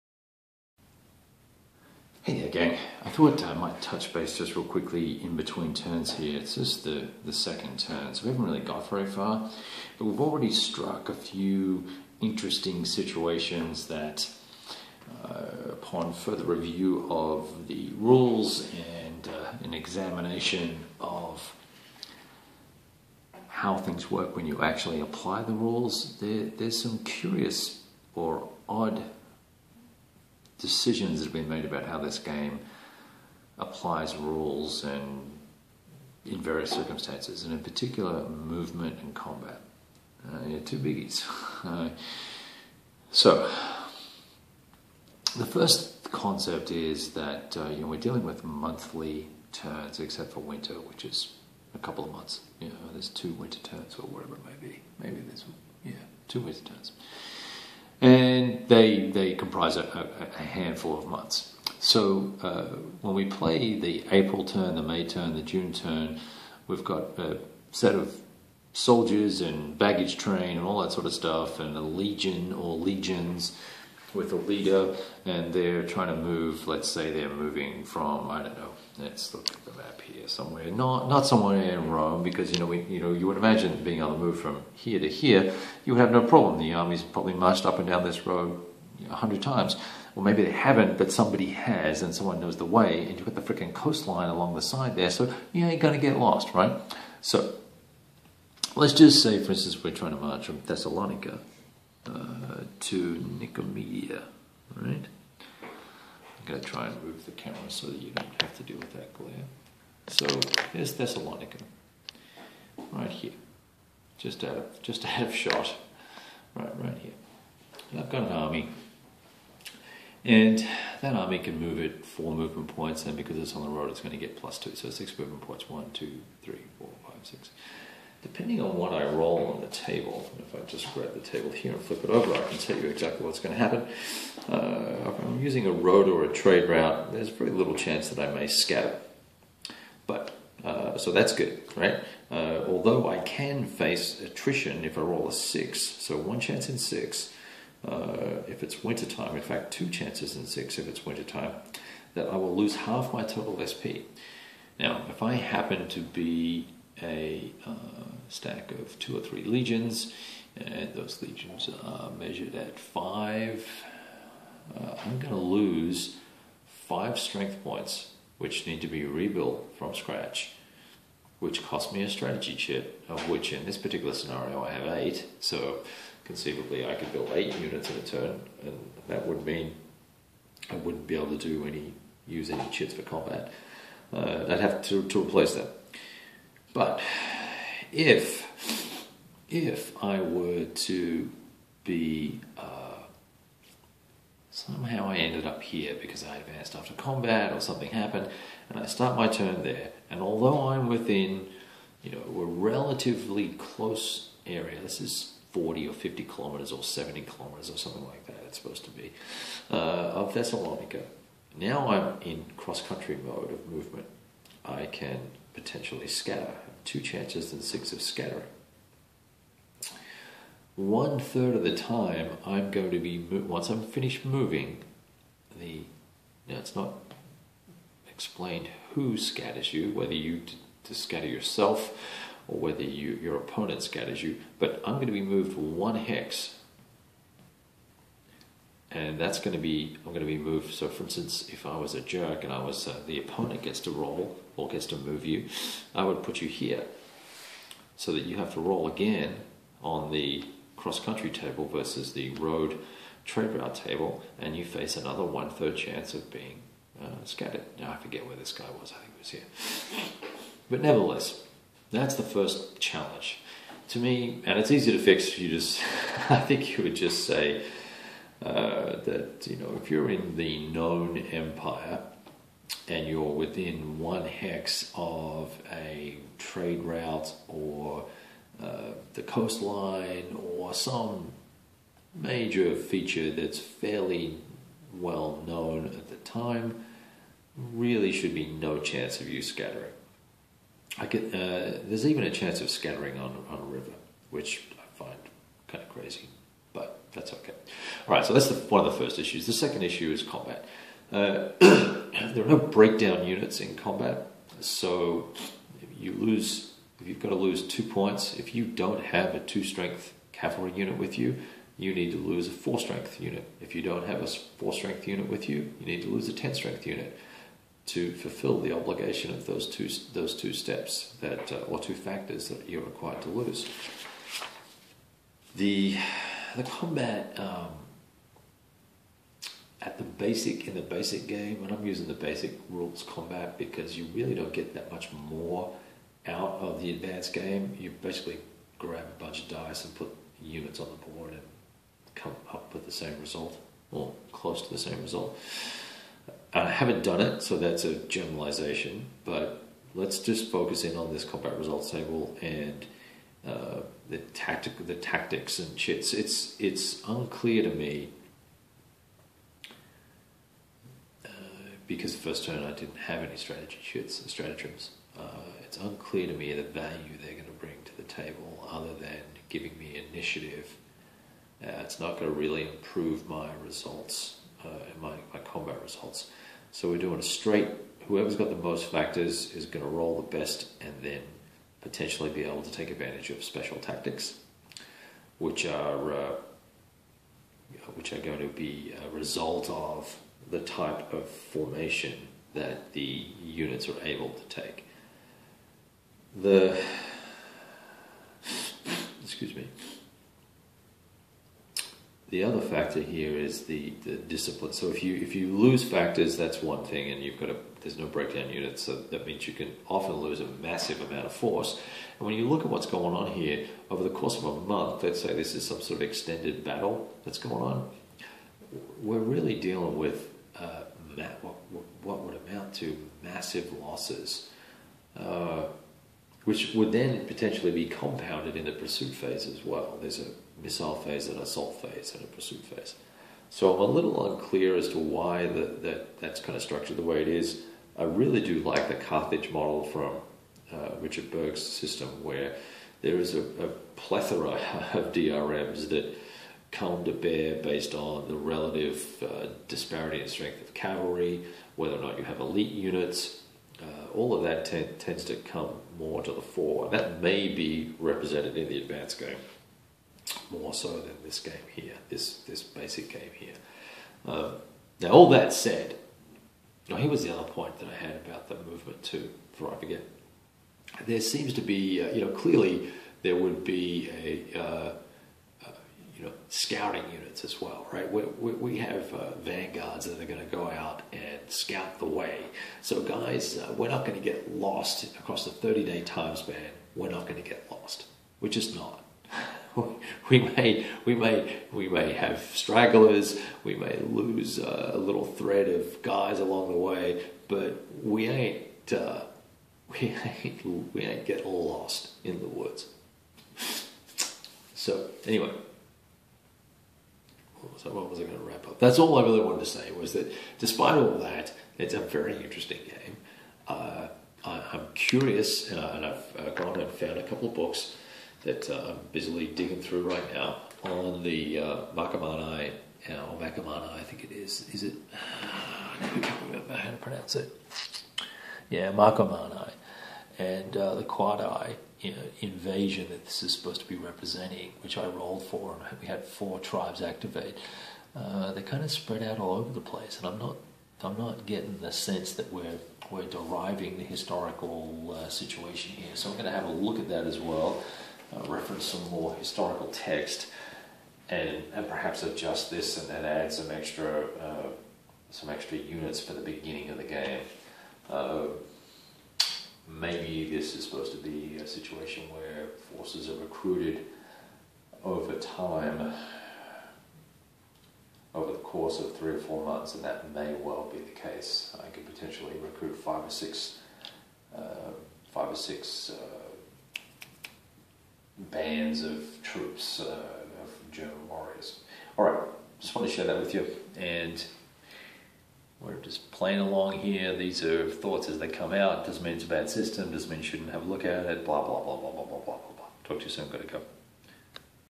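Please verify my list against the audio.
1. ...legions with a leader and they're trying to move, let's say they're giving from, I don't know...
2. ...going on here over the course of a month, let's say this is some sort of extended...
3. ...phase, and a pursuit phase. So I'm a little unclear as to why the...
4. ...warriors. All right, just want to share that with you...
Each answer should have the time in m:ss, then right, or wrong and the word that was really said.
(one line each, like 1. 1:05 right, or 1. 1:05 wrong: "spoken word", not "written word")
1. 1:12 wrong: "moving", not "giving"
2. 6:52 right
3. 7:11 right
4. 9:41 right.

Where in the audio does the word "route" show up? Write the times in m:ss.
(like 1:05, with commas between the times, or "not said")
2:16, 4:13, 4:36.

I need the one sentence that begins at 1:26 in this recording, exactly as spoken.
The army's probably marched up and down this road a hundred times.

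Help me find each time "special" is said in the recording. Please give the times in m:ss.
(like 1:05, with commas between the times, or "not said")
6:23.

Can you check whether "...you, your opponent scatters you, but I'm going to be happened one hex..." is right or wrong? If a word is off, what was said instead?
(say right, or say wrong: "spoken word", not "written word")
wrong: "moved", not "happened".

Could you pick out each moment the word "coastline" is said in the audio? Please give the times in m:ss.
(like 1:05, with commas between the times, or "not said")
1:33, 4:39.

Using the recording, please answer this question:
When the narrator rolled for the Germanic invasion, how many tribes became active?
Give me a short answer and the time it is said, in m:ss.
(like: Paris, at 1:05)
4, at 8:56.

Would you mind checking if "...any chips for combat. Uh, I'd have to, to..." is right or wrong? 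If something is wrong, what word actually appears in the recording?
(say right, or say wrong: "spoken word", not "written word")
right.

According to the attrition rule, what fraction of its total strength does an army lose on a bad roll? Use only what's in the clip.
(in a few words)
Half.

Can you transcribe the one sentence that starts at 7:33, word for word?
Uh, all of that t- tends to come more to the fore.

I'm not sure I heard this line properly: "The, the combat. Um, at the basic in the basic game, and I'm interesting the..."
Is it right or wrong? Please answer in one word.
wrong.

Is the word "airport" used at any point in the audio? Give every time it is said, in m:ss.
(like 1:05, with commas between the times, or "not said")
not said.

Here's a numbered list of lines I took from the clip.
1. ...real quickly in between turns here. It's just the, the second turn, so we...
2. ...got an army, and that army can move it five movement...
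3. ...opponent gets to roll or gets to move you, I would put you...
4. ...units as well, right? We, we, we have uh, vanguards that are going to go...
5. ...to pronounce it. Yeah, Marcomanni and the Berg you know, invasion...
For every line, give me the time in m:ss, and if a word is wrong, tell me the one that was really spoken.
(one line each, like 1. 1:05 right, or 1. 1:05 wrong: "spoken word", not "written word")
1. 0:04 right
2. 1:58 wrong: "four", not "five"
3. 4:03 right
4. 7:57 right
5. 8:46 wrong: "Quadi", not "Berg".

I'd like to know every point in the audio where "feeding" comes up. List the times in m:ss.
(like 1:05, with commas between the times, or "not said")
not said.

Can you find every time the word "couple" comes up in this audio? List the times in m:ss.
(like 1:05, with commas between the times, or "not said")
0:51, 8:37.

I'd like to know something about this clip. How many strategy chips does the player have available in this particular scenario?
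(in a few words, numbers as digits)
8.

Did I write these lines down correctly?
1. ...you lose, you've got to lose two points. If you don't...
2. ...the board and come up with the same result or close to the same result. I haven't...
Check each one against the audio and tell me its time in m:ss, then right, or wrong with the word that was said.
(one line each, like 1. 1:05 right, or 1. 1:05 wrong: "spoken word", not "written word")
1. 5:05 right
2. 5:40 right.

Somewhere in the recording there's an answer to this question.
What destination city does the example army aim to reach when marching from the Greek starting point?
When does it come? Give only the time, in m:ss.
1:43.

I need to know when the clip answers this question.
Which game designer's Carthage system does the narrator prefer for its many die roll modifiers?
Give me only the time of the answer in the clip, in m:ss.
7:20.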